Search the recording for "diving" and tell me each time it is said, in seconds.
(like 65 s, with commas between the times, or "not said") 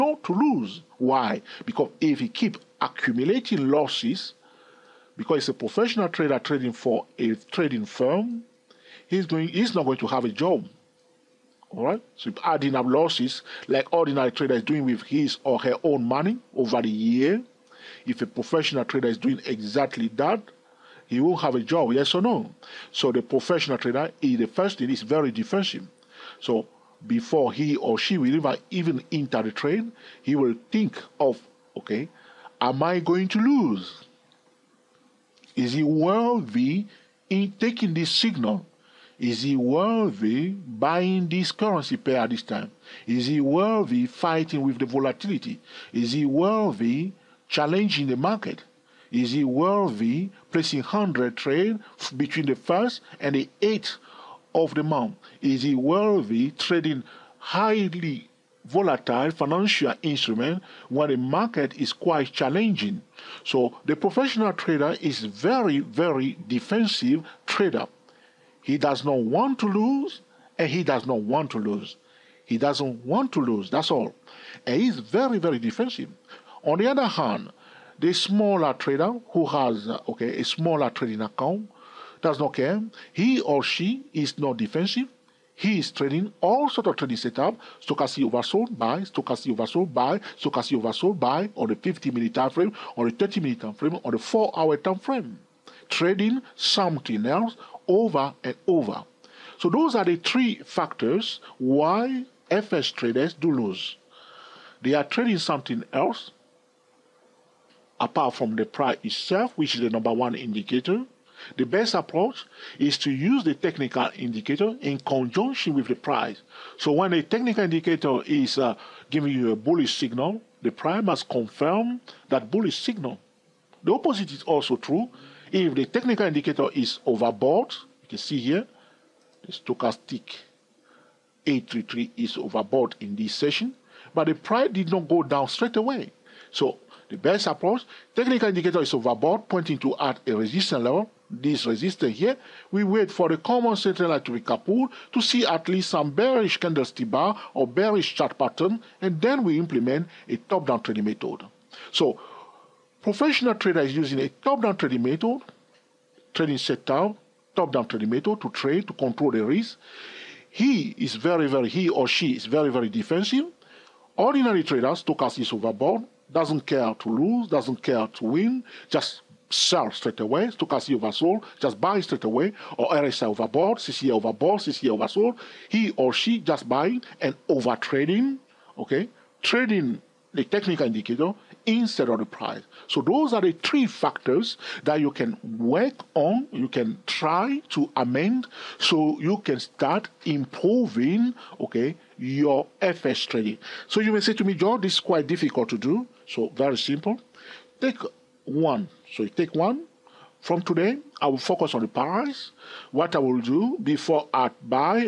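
not said.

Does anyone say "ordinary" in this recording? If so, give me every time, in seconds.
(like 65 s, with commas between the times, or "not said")
13 s, 164 s.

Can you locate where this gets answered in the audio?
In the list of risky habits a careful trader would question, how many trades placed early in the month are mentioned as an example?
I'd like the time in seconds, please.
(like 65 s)
50 s.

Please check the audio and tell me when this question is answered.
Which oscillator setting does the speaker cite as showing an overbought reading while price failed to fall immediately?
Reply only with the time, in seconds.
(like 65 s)
129 s.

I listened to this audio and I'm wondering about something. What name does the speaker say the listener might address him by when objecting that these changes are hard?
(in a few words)
George.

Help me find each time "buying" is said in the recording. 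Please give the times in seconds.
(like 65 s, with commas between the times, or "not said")
40 s, 176 s.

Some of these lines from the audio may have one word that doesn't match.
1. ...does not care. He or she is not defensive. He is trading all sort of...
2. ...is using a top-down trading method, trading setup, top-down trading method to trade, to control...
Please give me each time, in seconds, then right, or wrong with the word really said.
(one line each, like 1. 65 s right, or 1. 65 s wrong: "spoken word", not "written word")
1. 82 s right
2. 153 s right.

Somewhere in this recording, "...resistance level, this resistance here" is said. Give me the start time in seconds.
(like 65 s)
140 s.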